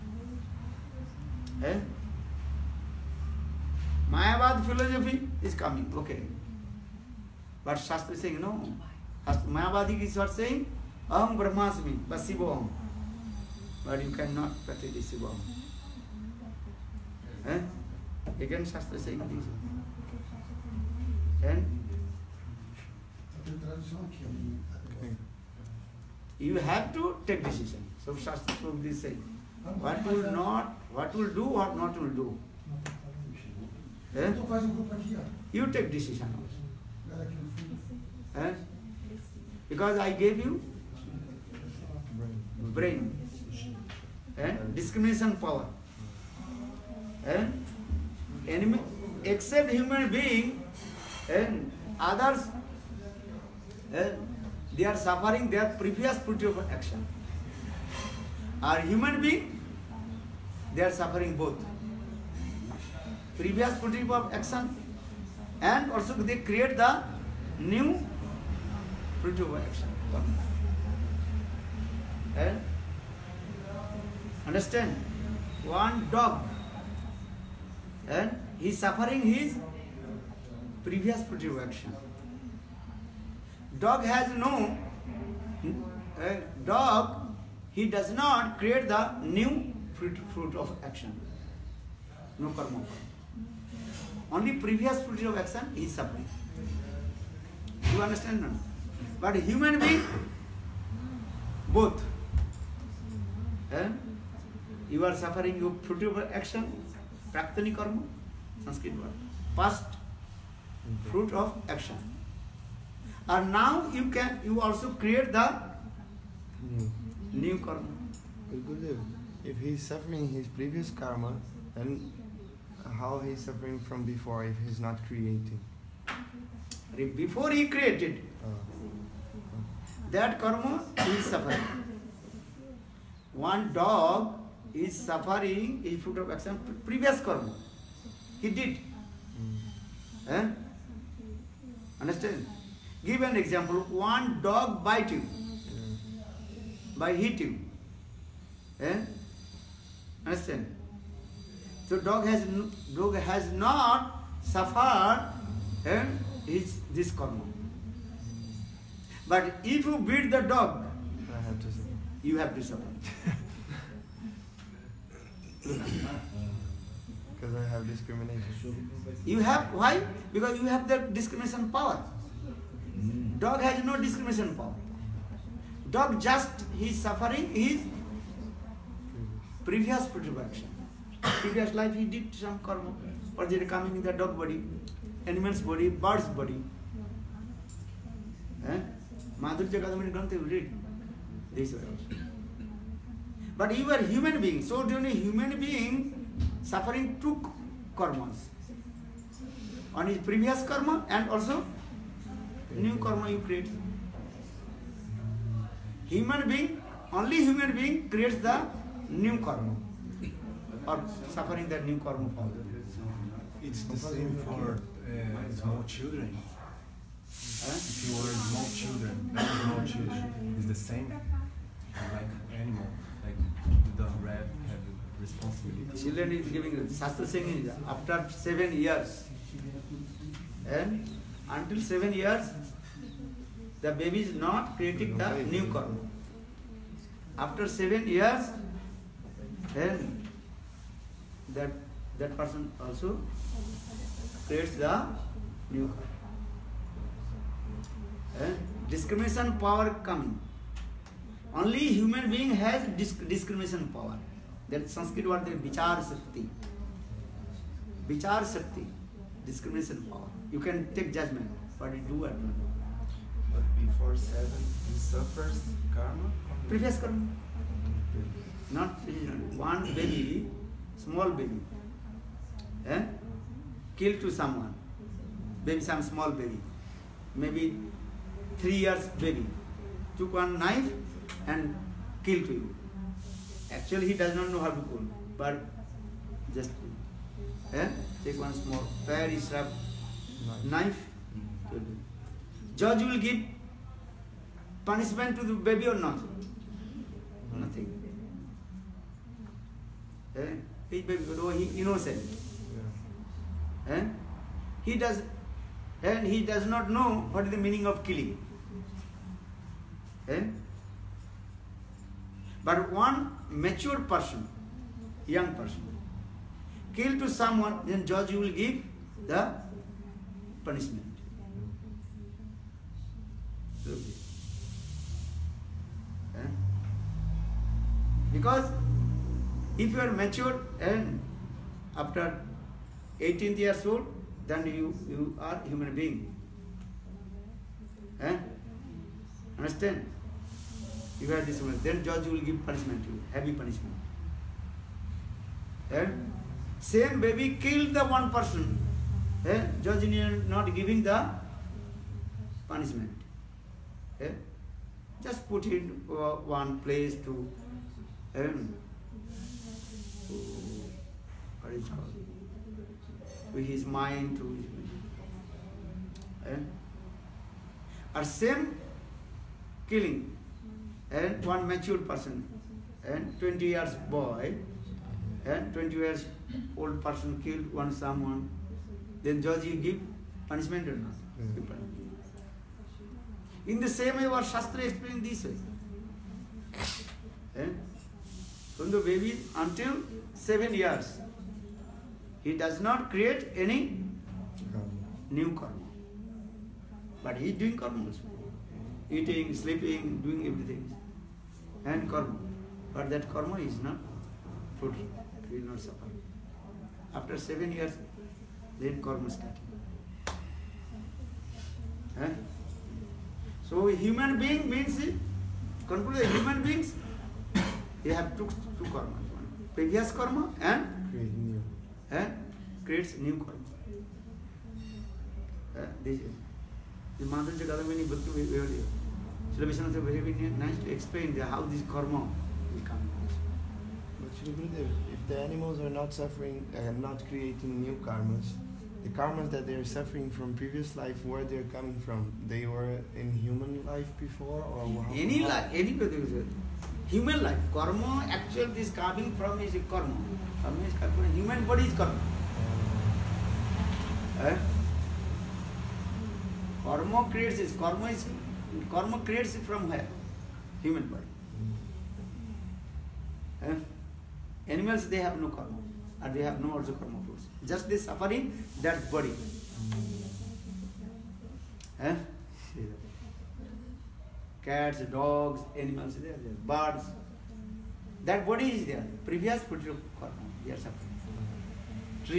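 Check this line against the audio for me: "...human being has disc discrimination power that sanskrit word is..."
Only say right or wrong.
right.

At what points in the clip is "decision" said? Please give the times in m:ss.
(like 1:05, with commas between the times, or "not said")
0:27, 0:35.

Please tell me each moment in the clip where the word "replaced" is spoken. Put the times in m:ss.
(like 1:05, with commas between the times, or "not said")
not said.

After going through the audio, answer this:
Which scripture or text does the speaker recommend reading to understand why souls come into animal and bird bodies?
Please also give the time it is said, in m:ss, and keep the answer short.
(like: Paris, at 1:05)
Madhurya Kadamini, at 3:09.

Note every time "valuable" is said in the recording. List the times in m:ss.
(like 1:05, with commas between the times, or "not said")
not said.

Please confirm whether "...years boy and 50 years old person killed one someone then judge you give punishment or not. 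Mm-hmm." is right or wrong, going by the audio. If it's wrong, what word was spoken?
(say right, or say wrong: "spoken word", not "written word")
wrong: "20", not "50".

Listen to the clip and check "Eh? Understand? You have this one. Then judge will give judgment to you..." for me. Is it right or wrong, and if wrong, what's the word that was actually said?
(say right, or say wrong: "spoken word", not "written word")
wrong: "punishment", not "judgment".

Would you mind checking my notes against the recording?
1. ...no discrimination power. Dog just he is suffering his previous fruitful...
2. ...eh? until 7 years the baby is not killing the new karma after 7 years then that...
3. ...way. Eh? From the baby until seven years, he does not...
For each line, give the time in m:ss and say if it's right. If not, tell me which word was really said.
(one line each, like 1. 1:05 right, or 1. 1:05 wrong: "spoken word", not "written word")
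1. 2:53 right
2. 3:51 wrong: "creating", not "killing"
3. 6:25 right.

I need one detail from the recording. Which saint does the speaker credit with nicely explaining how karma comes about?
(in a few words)
Srila Vishwanath.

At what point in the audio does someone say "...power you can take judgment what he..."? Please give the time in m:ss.
4:20.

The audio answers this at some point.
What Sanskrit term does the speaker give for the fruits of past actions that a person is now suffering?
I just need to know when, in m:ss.
1:47.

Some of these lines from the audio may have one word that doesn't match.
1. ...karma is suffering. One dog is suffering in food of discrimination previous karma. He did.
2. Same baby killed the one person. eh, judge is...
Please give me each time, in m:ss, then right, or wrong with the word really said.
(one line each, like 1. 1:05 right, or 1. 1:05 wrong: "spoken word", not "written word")
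1. 2:10 wrong: "action", not "discrimination"
2. 5:46 right.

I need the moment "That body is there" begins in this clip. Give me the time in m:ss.
7:58.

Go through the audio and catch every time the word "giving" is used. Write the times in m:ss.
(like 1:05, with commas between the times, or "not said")
3:46, 5:50.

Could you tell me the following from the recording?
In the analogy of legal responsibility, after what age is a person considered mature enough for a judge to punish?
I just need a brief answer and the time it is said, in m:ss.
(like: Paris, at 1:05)
18, at 5:33.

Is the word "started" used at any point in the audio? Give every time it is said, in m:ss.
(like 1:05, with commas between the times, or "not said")
6:49.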